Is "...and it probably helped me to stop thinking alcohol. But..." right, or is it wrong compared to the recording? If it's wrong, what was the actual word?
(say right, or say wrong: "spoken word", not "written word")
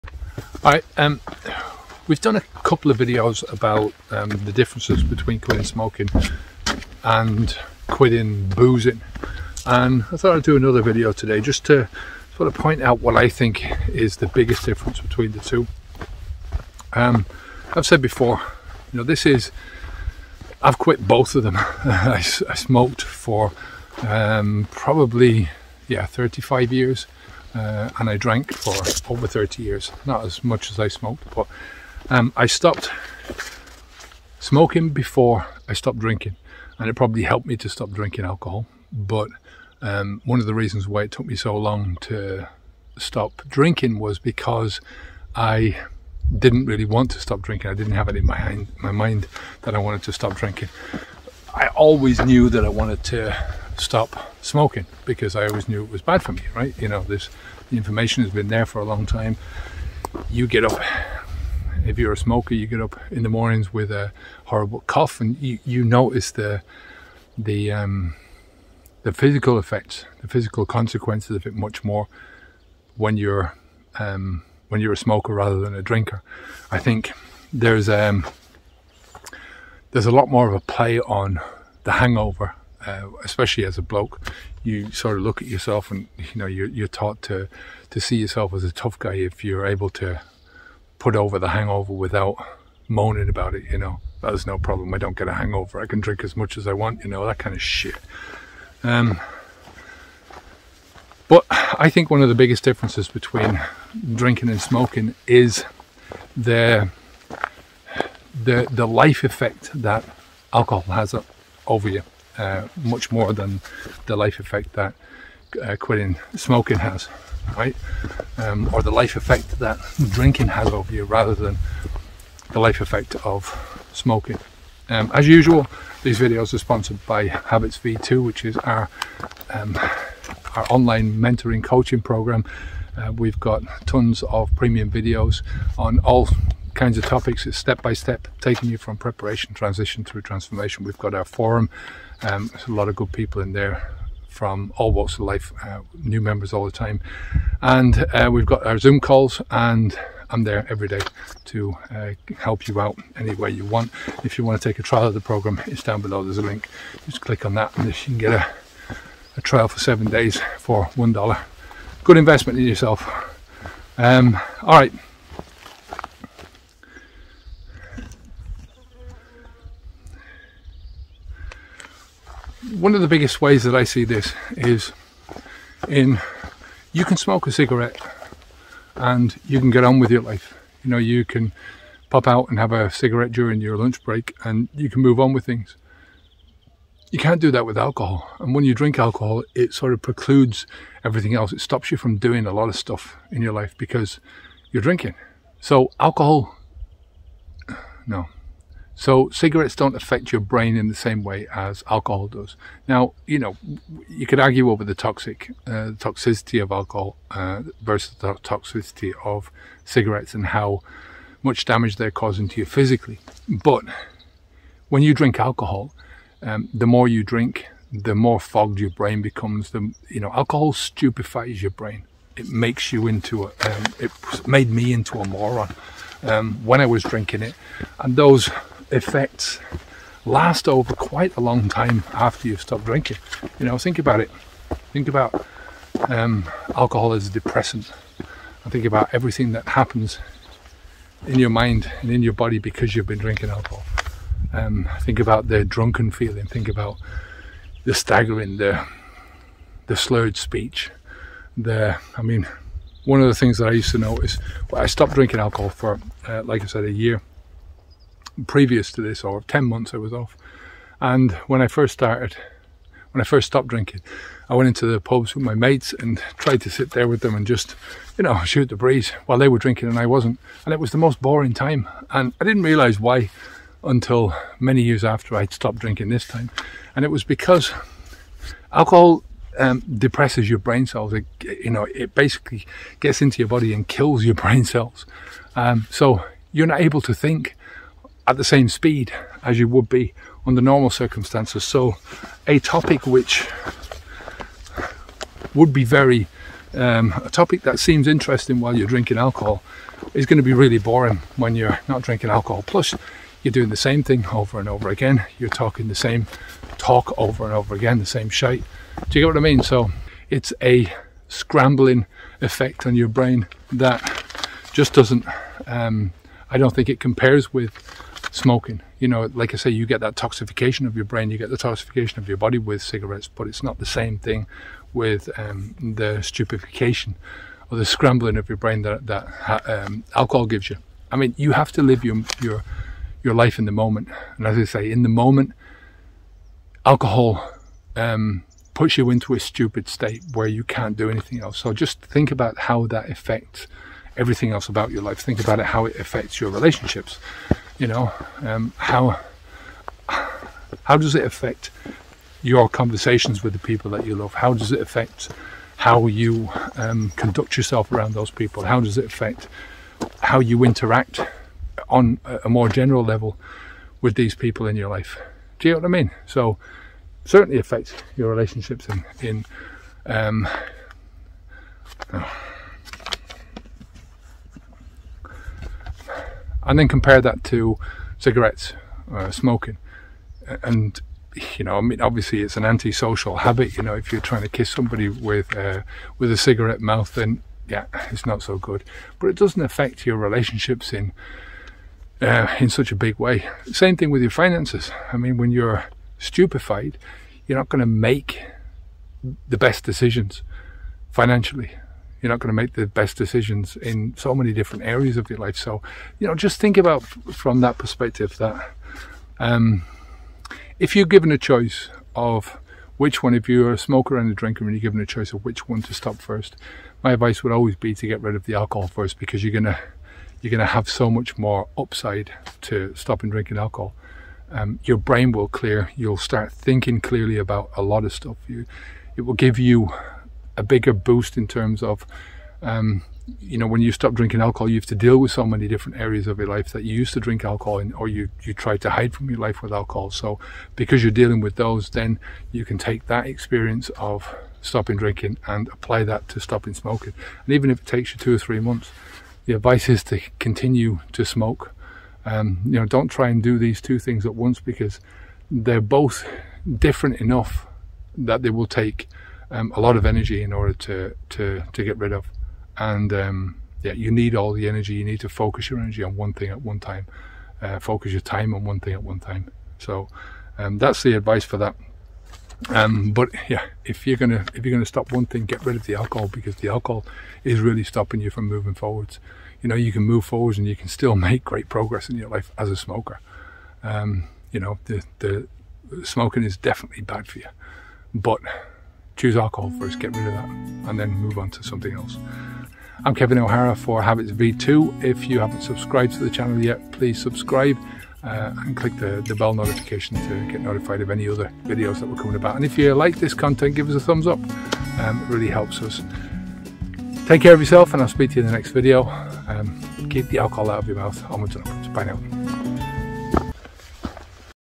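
wrong: "drinking", not "thinking".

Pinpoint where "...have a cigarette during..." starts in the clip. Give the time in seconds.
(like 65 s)
182 s.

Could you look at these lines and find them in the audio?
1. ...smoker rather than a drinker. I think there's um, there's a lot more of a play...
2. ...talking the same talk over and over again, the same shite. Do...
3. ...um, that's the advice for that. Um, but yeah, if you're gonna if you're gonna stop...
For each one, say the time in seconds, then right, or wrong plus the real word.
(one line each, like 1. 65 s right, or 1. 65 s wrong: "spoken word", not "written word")
1. 74 s right
2. 305 s right
3. 470 s right.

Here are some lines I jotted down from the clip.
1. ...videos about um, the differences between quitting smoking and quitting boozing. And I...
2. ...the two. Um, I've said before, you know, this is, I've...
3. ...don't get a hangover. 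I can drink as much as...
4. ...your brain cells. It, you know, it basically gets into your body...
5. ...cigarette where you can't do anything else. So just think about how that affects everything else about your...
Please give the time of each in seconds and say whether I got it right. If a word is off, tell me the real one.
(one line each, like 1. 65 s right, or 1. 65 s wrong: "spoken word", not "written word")
1. 2 s right
2. 15 s right
3. 94 s right
4. 280 s right
5. 339 s wrong: "state", not "cigarette".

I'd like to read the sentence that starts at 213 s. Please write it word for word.
But when you drink alcohol, um, the more you drink, the more fogged your brain becomes.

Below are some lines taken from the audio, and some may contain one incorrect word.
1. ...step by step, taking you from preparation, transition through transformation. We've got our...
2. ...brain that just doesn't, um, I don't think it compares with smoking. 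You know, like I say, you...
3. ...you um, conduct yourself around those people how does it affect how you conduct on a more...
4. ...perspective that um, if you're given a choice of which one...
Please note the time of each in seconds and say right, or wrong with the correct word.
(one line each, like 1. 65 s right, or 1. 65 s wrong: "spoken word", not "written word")
1. 137 s right
2. 313 s right
3. 356 s wrong: "interact", not "conduct"
4. 407 s right.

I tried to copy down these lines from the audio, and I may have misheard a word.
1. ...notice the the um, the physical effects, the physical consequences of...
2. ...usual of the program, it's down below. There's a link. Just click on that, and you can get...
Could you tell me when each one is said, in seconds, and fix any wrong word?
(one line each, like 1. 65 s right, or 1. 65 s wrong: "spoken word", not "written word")
1. 65 s right
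2. 154 s wrong: "trial", not "usual".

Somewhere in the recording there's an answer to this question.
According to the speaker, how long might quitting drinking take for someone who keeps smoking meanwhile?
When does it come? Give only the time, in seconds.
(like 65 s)
448 s.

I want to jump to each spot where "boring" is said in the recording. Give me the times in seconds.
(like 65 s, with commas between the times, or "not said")
271 s, 300 s.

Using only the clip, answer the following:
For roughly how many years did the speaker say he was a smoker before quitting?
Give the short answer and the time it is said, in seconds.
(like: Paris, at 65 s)
35 years, at 26 s.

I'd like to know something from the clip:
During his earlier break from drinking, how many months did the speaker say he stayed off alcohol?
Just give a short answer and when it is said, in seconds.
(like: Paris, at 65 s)
10 months, at 259 s.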